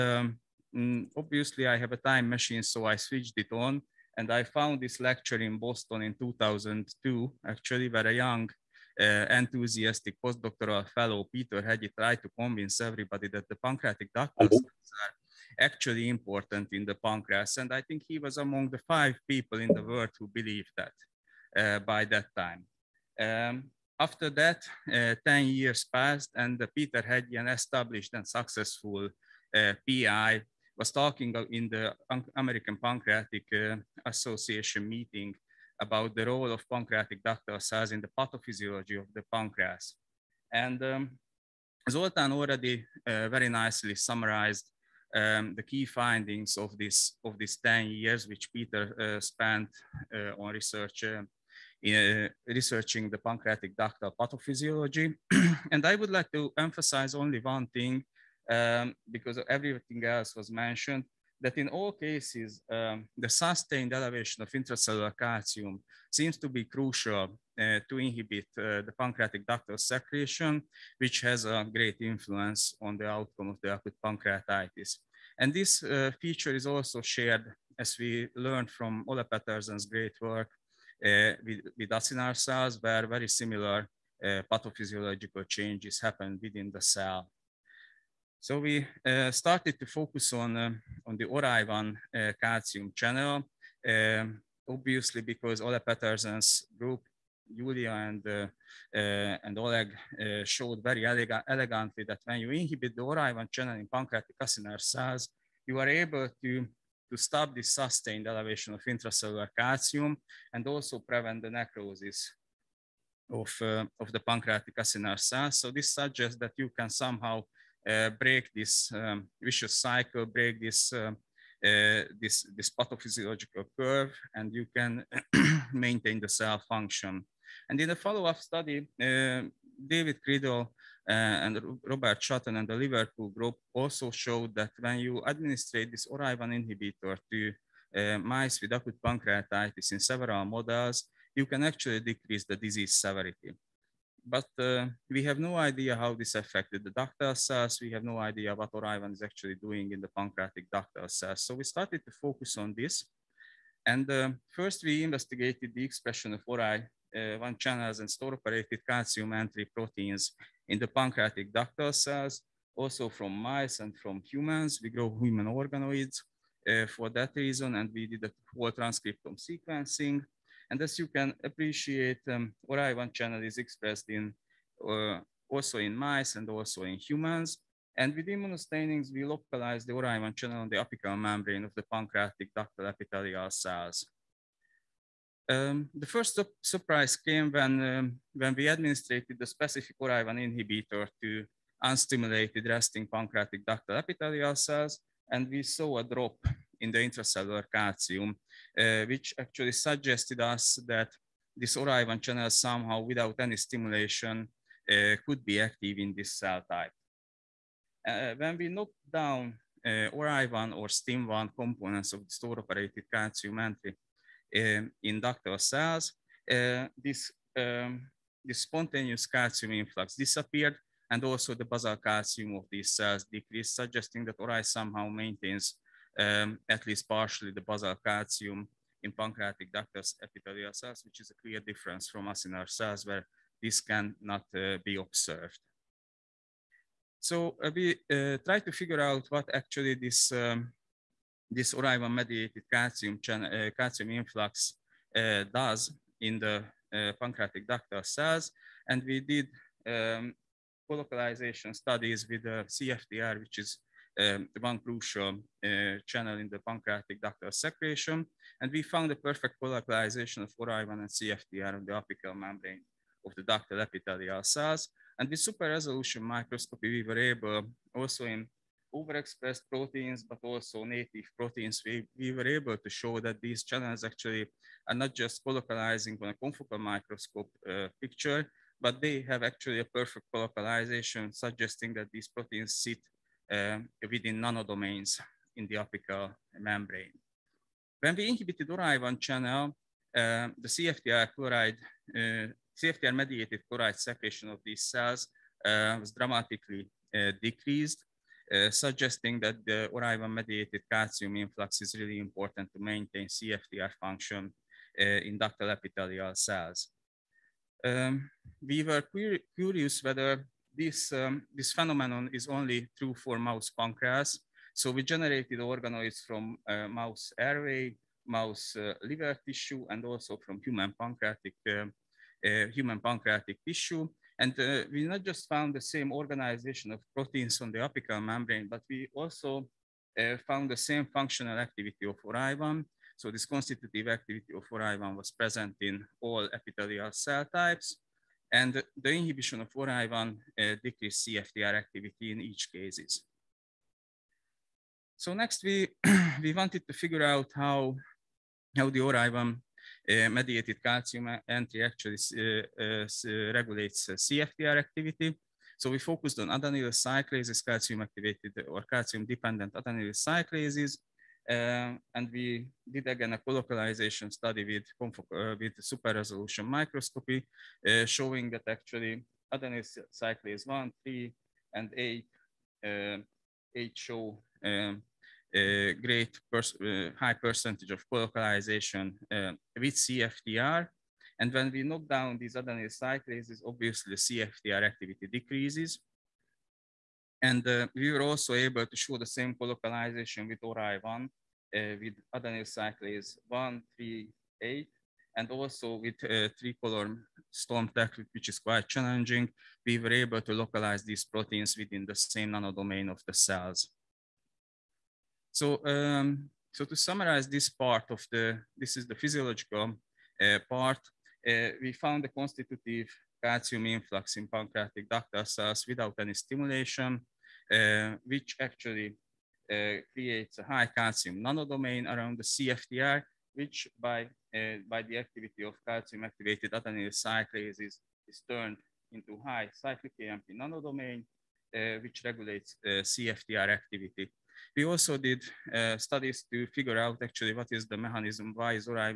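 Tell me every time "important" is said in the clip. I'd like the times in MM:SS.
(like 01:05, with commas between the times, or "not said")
00:16, 05:02.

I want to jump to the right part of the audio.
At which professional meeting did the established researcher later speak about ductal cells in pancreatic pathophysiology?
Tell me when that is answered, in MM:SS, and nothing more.
00:32.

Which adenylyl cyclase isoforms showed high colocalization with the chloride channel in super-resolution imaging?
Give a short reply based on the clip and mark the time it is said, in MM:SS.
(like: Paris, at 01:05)
1, 3, and 8, at 06:10.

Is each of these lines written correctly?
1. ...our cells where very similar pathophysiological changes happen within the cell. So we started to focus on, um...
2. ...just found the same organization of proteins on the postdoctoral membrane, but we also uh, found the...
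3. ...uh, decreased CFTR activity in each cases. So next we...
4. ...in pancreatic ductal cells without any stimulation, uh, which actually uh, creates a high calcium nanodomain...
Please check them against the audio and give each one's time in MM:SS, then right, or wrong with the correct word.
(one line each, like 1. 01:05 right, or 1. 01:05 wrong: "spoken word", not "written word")
1. 01:22 right
2. 05:25 wrong: "apical", not "postdoctoral"
3. 05:40 right
4. 06:54 right.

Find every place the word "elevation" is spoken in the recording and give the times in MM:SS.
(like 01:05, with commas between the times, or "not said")
01:03, 01:48.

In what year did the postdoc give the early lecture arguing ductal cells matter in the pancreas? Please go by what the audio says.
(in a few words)
2002.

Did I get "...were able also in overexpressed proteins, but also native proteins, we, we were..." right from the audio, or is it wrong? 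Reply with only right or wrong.
right.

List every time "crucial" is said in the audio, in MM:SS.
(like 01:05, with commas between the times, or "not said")
01:06, 04:14.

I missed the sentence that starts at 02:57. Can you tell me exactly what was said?
And with immunostainings, we localize the Orai1 channel on the apical membrane of the pancreatic ductal epithelial cells.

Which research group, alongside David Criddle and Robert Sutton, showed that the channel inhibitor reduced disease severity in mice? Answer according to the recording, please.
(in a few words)
Liverpool group.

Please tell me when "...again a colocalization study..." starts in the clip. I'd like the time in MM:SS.
06:03.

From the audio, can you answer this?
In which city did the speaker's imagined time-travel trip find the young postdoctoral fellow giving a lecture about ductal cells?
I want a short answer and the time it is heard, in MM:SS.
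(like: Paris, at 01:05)
Boston, at 00:05.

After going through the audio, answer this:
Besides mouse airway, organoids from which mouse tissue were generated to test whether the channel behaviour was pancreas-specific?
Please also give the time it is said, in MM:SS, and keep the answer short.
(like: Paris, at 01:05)
Liver, at 05:19.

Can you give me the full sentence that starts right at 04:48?
When we inhibited Orai1 channel, uh, the CFTR chloride, uh, CFTR mediated chloride secretion of these cells uh, was dramatically uh, decreased.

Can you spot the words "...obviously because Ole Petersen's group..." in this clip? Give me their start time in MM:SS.
01:34.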